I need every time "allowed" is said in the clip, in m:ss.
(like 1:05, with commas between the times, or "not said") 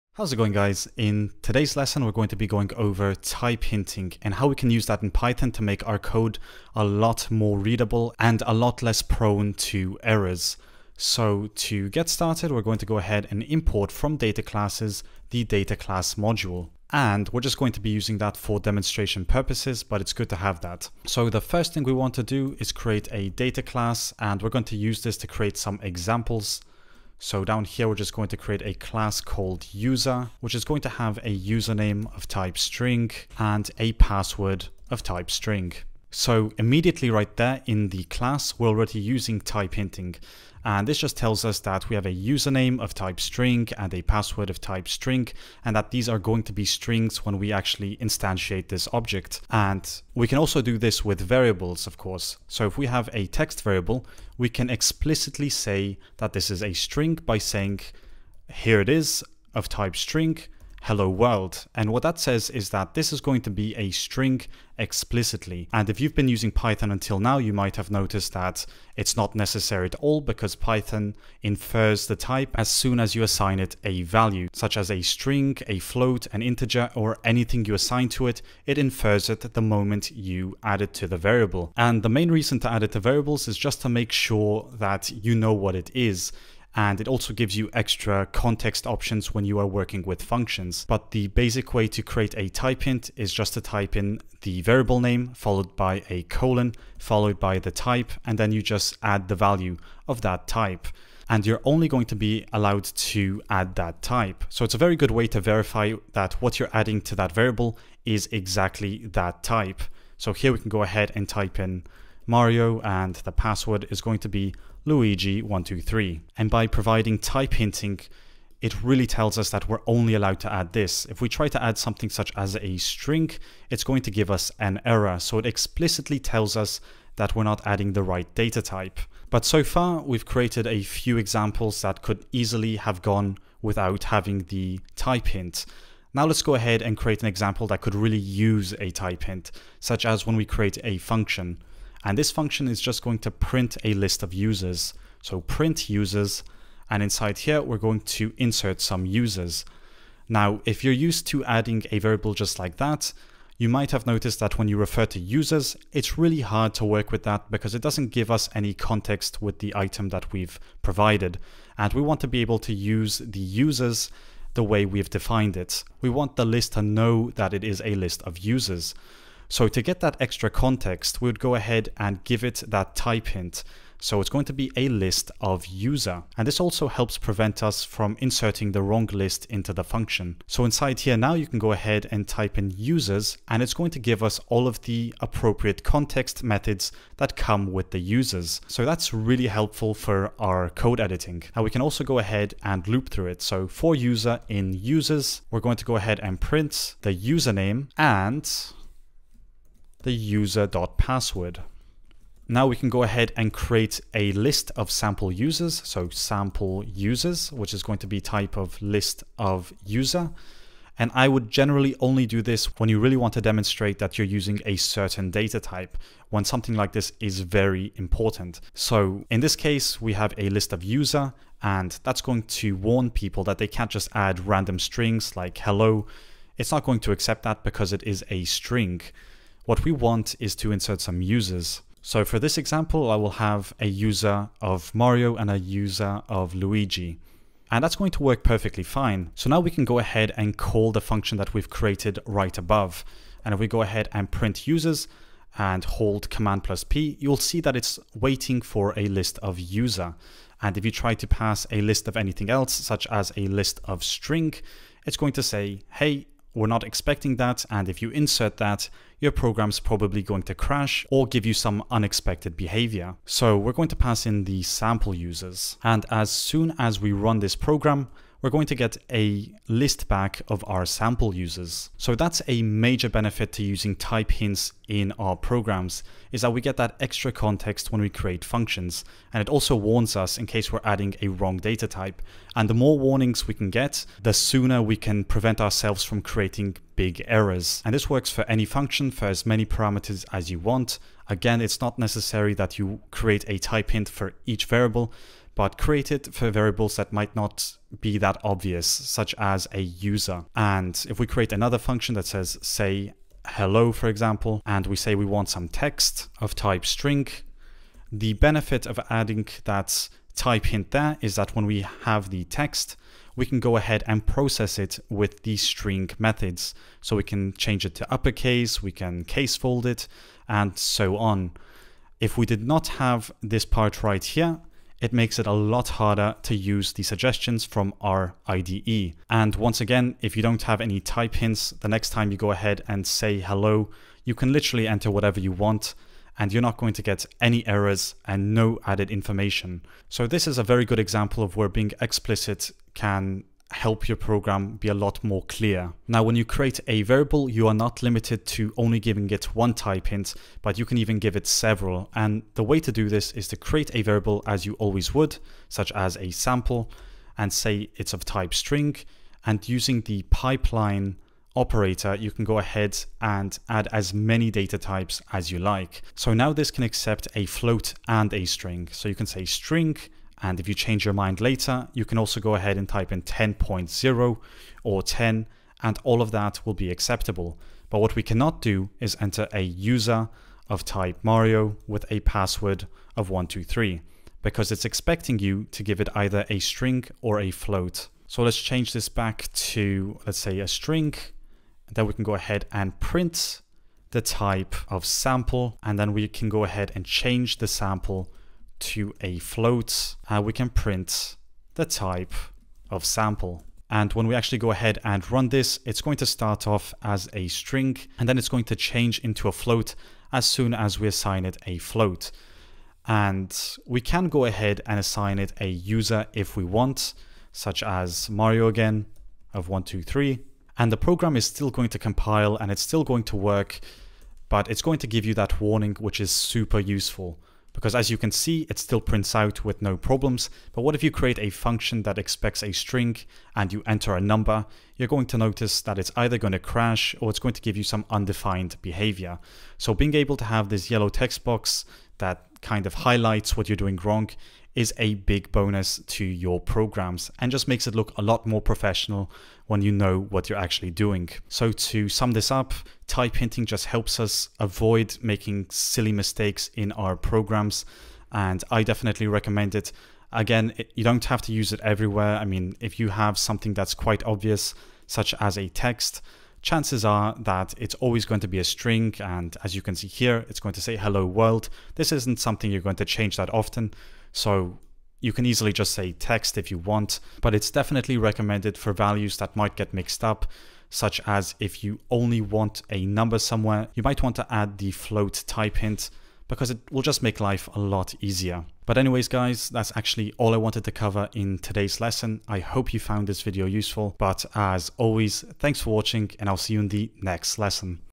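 1:42, 2:00.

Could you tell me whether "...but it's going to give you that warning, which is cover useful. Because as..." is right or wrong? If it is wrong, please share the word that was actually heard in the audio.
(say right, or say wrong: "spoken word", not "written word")
wrong: "super", not "cover".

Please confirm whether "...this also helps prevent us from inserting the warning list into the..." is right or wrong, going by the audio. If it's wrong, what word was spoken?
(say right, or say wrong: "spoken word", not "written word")
wrong: "wrong", not "warning".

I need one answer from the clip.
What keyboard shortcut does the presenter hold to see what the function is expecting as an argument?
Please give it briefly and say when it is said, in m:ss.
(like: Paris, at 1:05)
command plus P, at 4:06.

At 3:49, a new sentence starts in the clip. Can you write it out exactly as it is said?
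What we want is to insert some users.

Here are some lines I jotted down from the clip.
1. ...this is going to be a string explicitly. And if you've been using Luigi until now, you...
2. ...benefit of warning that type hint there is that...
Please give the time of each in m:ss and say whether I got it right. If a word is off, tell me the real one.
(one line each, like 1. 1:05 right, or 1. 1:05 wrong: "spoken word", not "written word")
1. 1:02 wrong: "Python", not "Luigi"
2. 5:08 wrong: "adding", not "warning".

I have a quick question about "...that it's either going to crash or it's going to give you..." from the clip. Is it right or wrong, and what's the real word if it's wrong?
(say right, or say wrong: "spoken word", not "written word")
right.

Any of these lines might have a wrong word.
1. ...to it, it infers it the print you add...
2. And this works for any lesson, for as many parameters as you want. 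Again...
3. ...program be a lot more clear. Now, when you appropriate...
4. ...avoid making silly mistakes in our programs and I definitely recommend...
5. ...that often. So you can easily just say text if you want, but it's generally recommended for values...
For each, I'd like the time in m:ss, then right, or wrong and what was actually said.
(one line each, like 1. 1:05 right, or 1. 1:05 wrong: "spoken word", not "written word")
1. 1:18 wrong: "moment", not "print"
2. 4:47 wrong: "function", not "lesson"
3. 5:44 wrong: "create", not "appropriate"
4. 7:34 right
5. 7:53 wrong: "definitely", not "generally".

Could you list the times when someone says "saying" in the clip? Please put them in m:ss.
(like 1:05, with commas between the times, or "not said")
0:57.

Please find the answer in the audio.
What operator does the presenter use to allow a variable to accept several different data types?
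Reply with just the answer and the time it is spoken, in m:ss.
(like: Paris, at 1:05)
pipeline operator, at 6:00.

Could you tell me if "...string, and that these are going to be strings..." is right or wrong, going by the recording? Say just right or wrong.
right.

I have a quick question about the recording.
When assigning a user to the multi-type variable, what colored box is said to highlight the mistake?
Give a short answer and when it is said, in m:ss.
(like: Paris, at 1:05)
yellow, at 7:20.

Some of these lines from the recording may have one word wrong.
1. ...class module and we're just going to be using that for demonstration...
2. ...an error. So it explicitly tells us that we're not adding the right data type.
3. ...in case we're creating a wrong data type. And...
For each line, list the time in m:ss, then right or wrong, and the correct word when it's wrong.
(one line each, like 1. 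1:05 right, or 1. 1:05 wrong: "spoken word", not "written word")
1. 0:15 right
2. 2:04 right
3. 4:40 wrong: "adding", not "creating".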